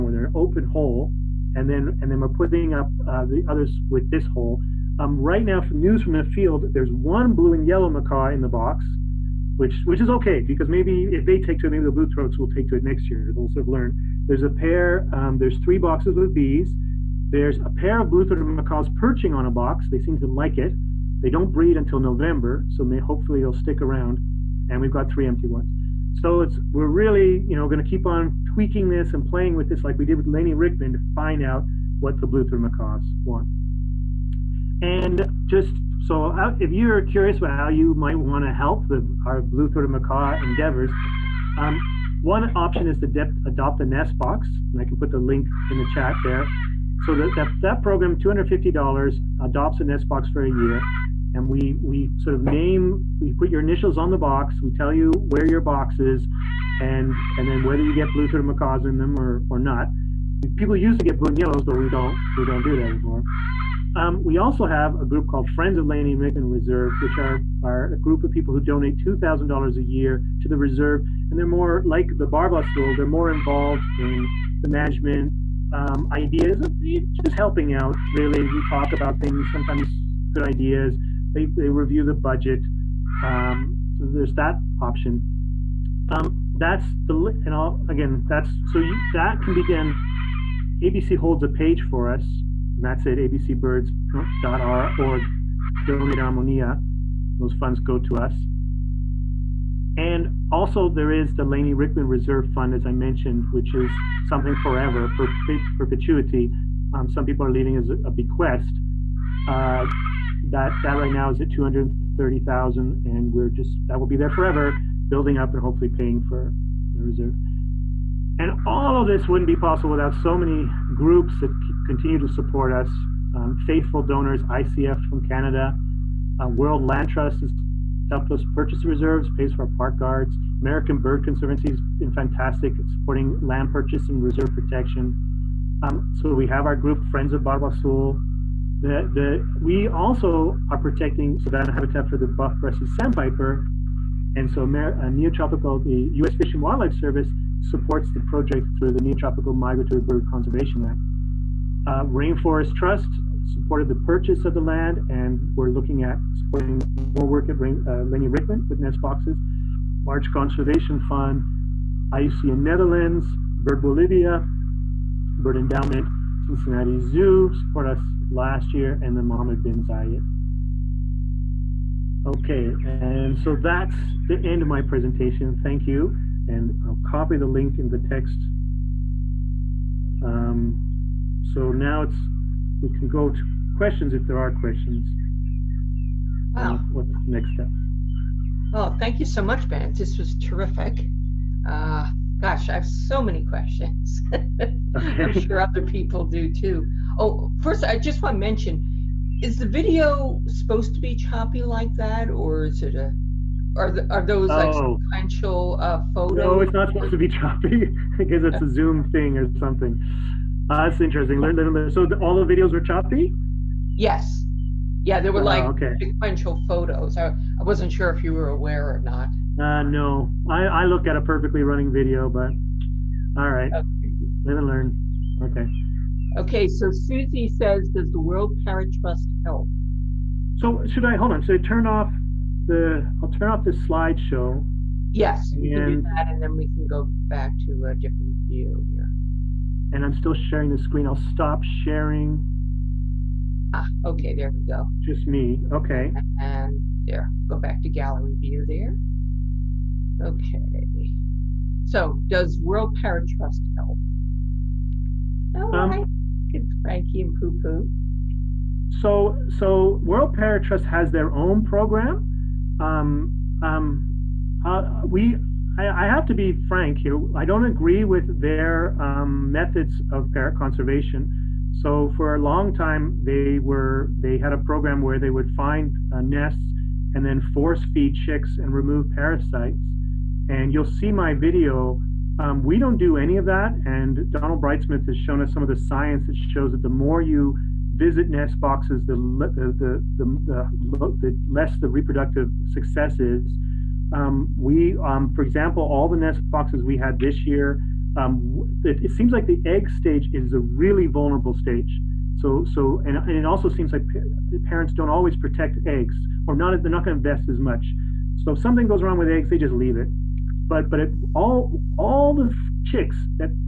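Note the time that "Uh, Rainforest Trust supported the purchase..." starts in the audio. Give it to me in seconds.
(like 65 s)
151 s.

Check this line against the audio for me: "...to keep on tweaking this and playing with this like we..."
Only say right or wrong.
right.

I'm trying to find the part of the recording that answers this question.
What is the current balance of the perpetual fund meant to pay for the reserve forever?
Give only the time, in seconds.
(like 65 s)
111 s.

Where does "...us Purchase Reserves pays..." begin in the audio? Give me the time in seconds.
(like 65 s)
128 s.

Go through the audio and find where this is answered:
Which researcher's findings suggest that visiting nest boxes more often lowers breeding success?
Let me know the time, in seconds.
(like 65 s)
284 s.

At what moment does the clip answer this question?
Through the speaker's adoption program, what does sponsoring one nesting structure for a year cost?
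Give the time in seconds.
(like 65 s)
48 s.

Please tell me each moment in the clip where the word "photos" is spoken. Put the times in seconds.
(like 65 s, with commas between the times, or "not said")
206 s, 216 s.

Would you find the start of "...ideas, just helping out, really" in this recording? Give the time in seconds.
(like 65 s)
76 s.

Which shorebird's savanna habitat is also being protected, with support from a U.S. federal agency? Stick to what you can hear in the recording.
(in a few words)
buff-breasted sandpiper.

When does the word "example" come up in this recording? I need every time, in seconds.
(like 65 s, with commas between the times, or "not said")
295 s.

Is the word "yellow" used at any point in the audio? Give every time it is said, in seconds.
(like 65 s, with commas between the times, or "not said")
7 s, 61 s.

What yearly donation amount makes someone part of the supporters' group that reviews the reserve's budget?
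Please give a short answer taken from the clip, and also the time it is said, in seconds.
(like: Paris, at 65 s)
$2,000, at 69 s.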